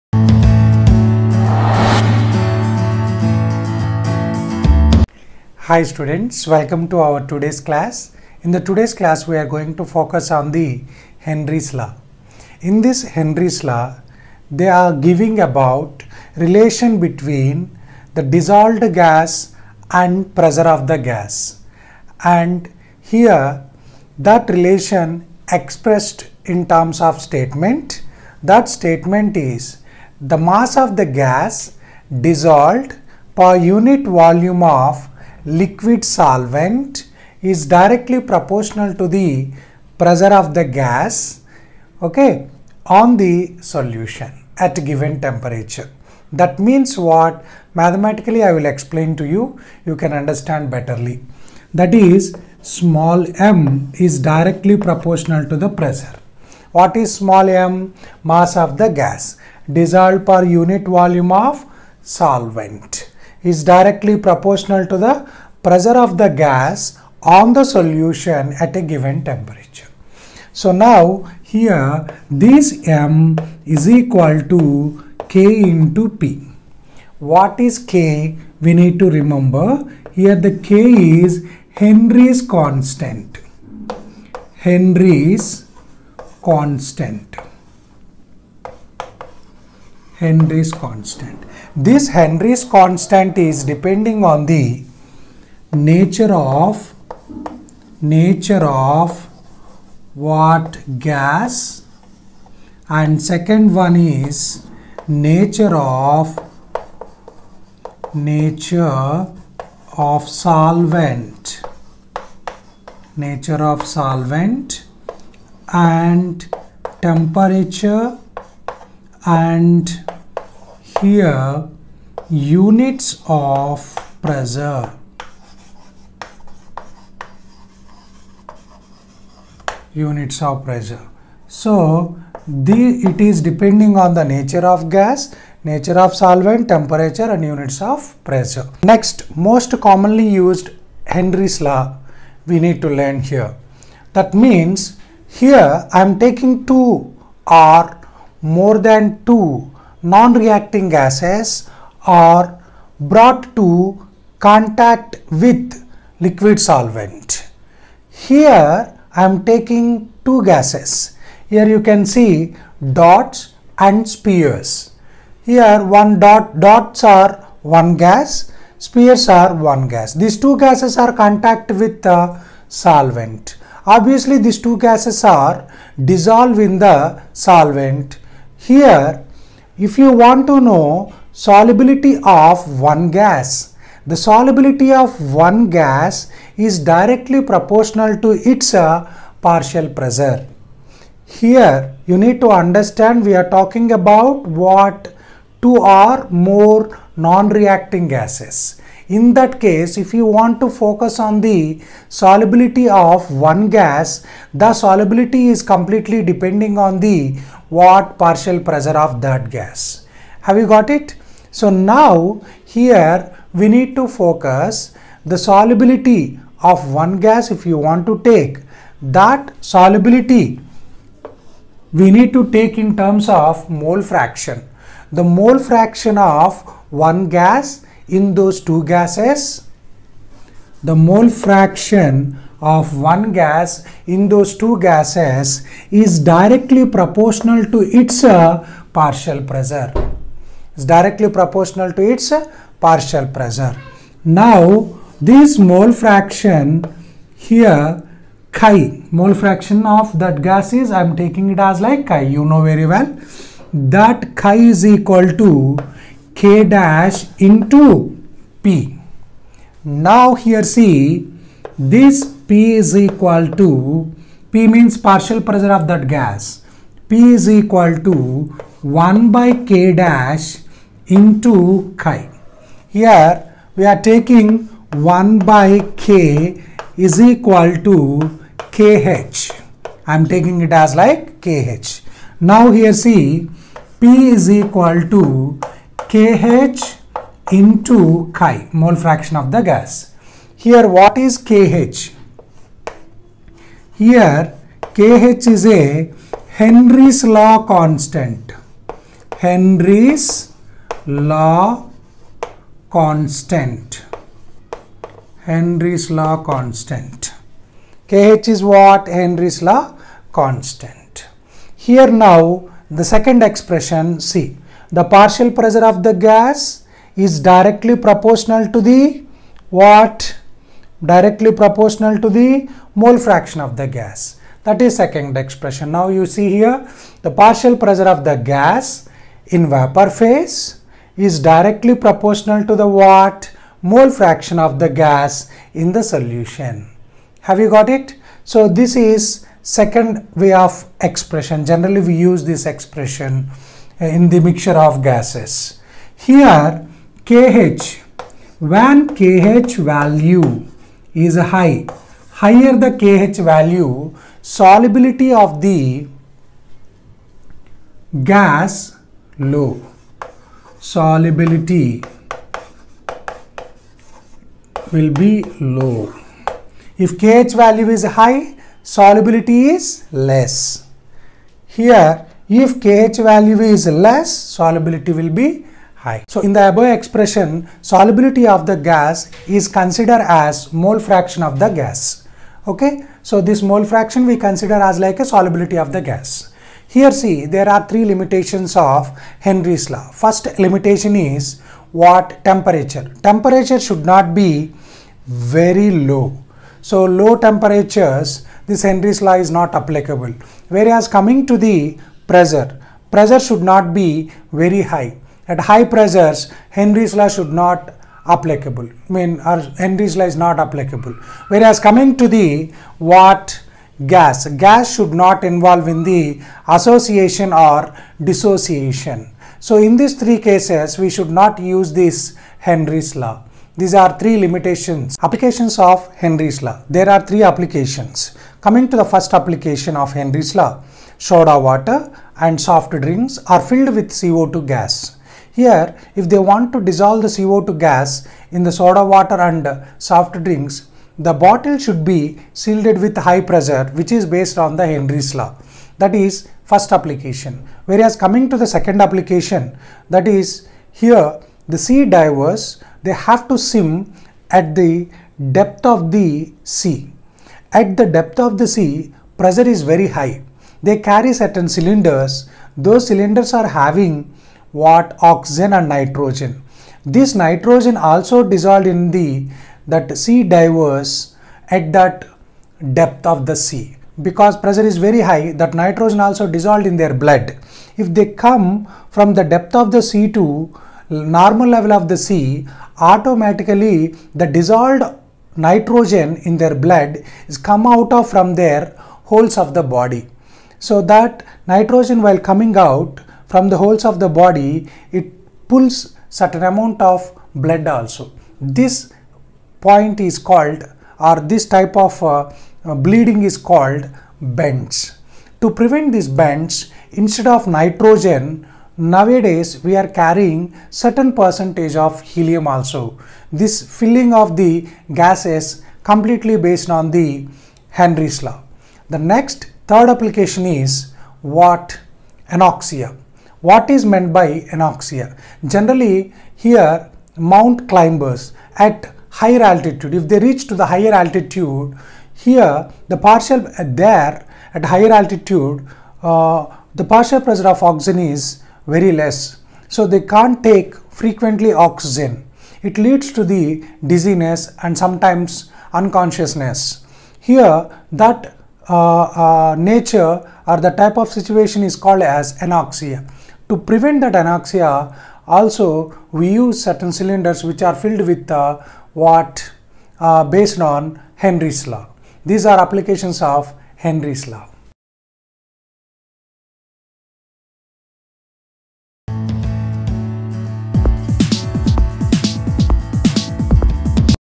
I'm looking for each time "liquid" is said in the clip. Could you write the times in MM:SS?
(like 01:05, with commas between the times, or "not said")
00:35, 02:36.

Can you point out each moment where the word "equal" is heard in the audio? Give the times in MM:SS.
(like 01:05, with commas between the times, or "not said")
01:13, 04:14, 04:22, 04:27, 04:37, 04:44.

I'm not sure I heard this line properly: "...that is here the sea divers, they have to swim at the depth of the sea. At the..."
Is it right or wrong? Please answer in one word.
right.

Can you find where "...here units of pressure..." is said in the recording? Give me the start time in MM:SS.
02:01.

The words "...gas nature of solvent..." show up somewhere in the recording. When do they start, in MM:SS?
02:14.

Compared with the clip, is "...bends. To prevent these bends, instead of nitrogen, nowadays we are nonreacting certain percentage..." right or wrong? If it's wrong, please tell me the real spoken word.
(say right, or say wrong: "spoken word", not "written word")
wrong: "carrying", not "nonreacting".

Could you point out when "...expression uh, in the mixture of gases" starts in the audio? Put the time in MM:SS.
05:42.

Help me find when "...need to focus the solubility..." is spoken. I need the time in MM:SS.
03:33.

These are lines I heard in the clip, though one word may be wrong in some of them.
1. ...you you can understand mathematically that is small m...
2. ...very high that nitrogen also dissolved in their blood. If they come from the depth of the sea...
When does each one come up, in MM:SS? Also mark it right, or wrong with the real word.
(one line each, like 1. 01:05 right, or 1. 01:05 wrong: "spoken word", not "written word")
1. 00:49 wrong: "betterly", not "mathematically"
2. 07:54 right.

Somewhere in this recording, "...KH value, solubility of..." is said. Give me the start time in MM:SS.
05:52.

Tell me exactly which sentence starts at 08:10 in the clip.
So that nitrogen while coming out from the holes of the body, it pulls certain amount of blood also.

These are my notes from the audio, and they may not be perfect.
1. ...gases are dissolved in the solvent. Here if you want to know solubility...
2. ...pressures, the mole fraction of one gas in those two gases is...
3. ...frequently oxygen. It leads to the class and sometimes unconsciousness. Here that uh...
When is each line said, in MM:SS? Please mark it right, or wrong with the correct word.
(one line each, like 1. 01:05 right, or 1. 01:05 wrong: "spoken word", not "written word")
1. 02:54 right
2. 03:48 wrong: "gases", not "pressures"
3. 09:01 wrong: "dizziness", not "class".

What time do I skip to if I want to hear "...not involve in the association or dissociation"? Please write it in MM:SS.
06:55.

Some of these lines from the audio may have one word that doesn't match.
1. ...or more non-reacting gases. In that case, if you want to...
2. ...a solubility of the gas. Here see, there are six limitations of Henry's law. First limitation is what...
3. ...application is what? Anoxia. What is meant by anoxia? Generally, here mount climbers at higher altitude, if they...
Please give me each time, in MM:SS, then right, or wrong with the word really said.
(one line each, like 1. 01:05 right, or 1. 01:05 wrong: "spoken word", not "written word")
1. 03:15 right
2. 06:25 wrong: "three", not "six"
3. 08:40 right.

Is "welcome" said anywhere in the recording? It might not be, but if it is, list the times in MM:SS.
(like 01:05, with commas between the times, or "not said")
00:06.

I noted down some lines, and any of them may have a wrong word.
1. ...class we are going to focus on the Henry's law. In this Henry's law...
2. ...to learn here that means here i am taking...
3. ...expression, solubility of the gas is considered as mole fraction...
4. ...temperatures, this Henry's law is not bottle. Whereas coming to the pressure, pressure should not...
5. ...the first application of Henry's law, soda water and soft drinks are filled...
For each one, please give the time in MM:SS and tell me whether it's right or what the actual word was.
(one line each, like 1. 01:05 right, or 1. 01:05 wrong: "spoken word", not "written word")
1. 00:08 right
2. 02:22 right
3. 06:16 right
4. 06:37 wrong: "applicable", not "bottle"
5. 07:08 right.